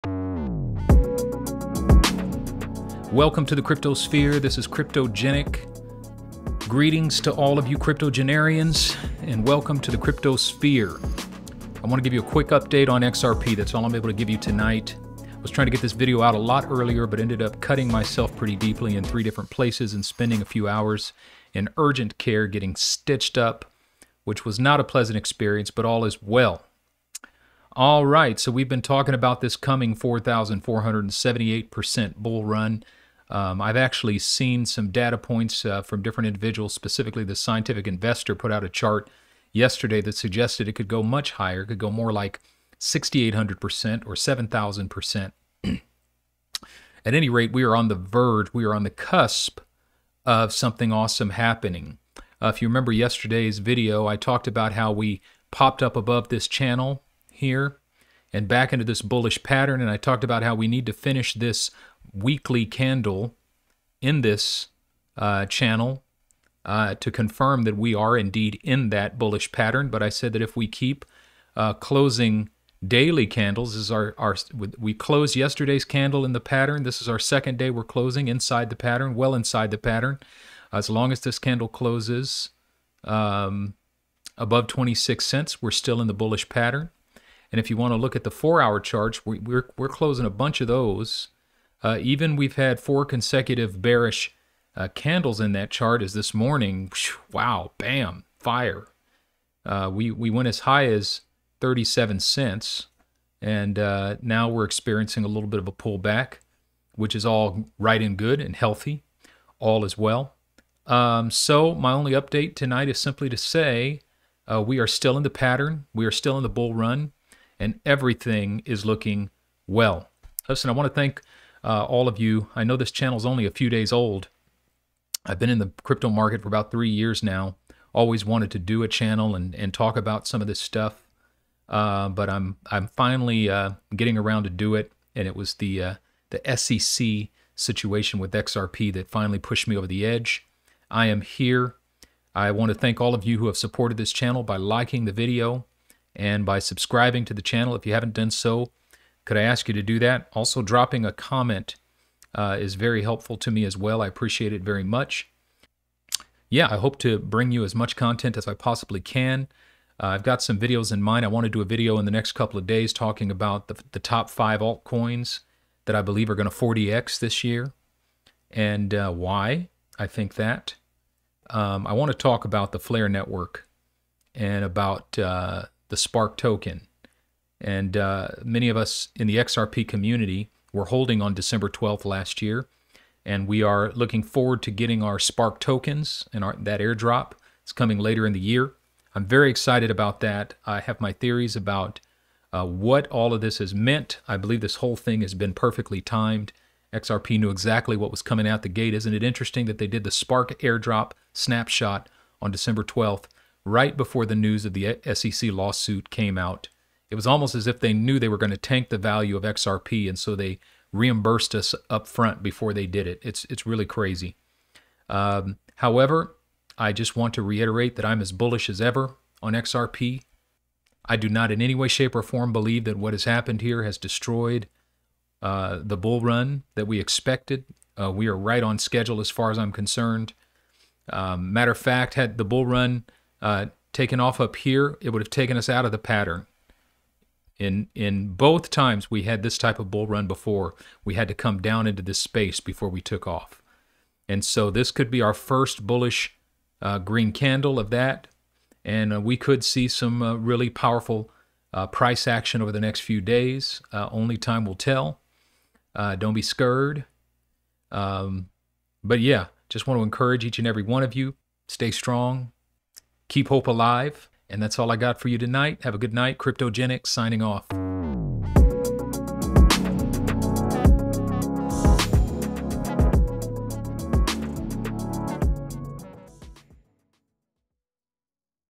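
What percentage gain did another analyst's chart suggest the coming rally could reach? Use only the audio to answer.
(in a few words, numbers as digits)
6,800%.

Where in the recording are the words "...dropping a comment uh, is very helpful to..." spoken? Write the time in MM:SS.
02:30.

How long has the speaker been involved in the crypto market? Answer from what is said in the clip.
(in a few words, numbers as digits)
about three years.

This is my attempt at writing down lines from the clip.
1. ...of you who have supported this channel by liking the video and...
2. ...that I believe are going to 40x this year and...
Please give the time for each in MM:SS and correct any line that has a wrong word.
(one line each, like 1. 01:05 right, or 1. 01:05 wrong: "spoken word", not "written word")
1. 02:23 right
2. 02:45 right.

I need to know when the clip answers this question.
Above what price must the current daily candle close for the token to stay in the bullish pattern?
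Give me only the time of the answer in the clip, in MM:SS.
01:24.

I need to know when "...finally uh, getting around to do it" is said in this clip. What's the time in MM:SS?
02:12.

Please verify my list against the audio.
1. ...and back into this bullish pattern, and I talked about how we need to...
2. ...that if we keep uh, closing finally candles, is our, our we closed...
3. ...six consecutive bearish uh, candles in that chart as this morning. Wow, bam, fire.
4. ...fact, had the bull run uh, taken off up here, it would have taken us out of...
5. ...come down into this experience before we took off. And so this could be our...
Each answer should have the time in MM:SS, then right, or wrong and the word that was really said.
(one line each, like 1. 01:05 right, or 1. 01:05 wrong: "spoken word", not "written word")
1. 00:58 right
2. 01:10 wrong: "daily", not "finally"
3. 01:32 wrong: "four", not "six"
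4. 03:51 right
5. 04:01 wrong: "space", not "experience".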